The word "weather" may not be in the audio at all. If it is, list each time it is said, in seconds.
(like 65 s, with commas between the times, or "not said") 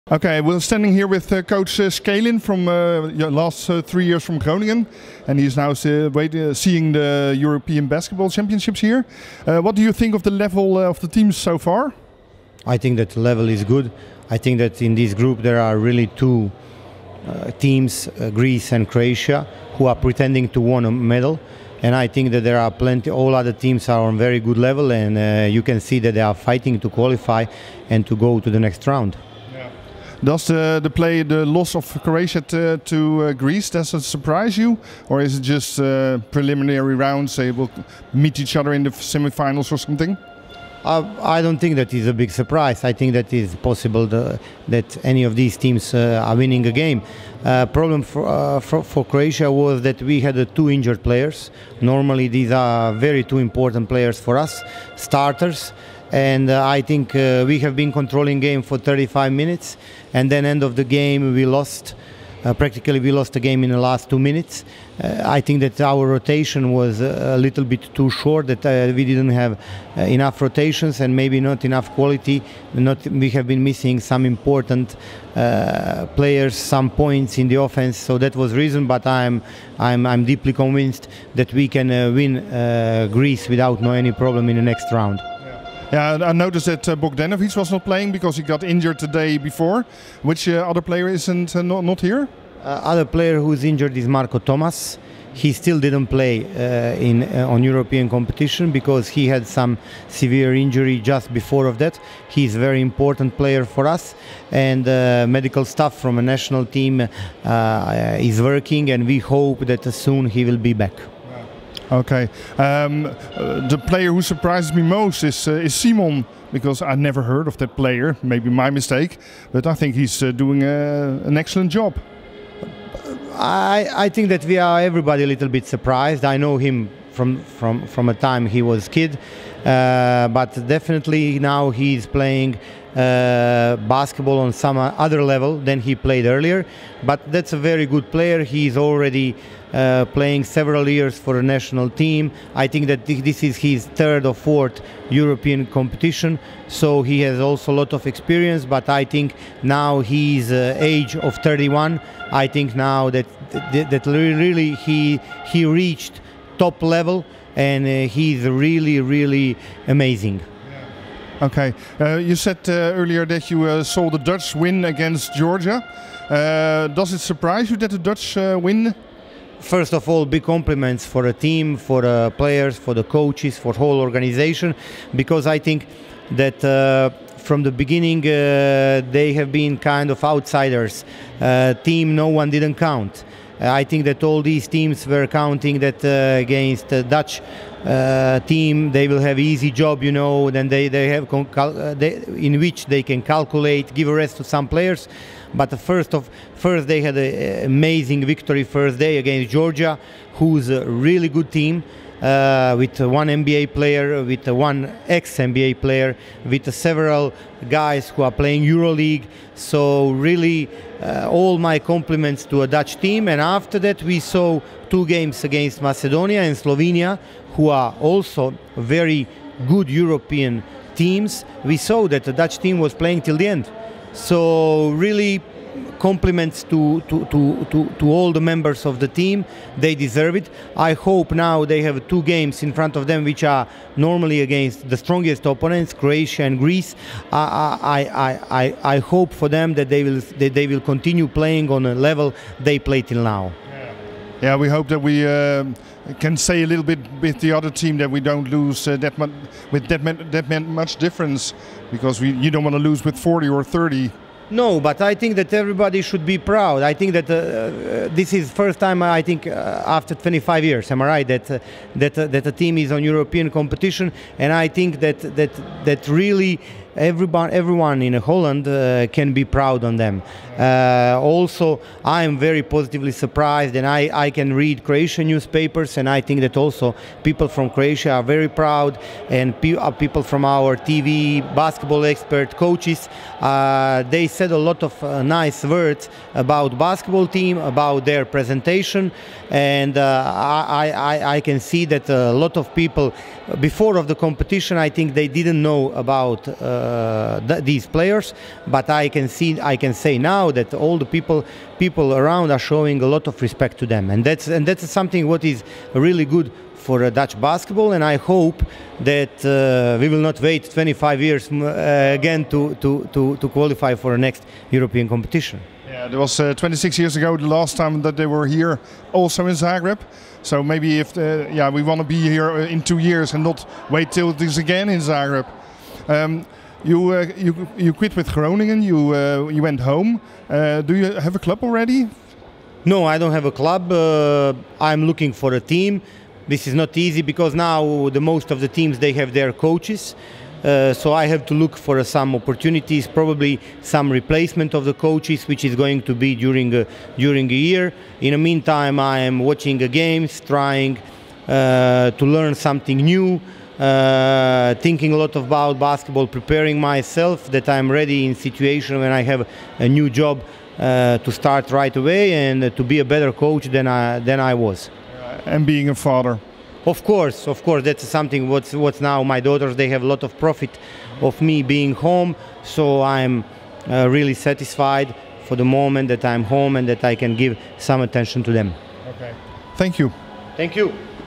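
not said.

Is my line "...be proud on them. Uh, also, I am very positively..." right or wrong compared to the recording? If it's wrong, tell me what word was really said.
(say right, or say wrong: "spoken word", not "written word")
right.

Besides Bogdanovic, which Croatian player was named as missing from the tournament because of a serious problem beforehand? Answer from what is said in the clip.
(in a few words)
Marko Tomas.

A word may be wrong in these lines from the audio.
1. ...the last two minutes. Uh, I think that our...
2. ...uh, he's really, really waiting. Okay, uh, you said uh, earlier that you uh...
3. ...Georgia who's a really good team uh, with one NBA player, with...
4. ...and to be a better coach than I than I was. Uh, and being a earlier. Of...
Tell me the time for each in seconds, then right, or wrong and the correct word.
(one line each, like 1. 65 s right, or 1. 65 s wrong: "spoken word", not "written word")
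1. 63 s right
2. 157 s wrong: "amazing", not "waiting"
3. 199 s right
4. 362 s wrong: "father", not "earlier".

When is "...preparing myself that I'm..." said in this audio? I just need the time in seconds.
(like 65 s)
356 s.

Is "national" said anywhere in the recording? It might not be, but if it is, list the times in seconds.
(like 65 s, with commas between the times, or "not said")
106 s, 141 s.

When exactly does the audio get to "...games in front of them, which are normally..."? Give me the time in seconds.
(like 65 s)
232 s.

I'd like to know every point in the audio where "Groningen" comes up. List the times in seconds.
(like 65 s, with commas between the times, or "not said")
4 s, 328 s.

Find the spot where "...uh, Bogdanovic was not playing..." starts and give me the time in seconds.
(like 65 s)
86 s.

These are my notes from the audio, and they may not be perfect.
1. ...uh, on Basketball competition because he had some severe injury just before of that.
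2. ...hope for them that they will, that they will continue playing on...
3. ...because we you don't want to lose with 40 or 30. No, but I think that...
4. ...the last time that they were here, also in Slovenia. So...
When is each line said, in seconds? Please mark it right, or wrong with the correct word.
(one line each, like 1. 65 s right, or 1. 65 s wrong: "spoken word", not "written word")
1. 97 s wrong: "European", not "Basketball"
2. 238 s right
3. 251 s right
4. 317 s wrong: "Zagreb", not "Slovenia".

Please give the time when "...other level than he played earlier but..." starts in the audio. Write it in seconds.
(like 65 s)
134 s.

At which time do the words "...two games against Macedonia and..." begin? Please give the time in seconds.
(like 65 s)
214 s.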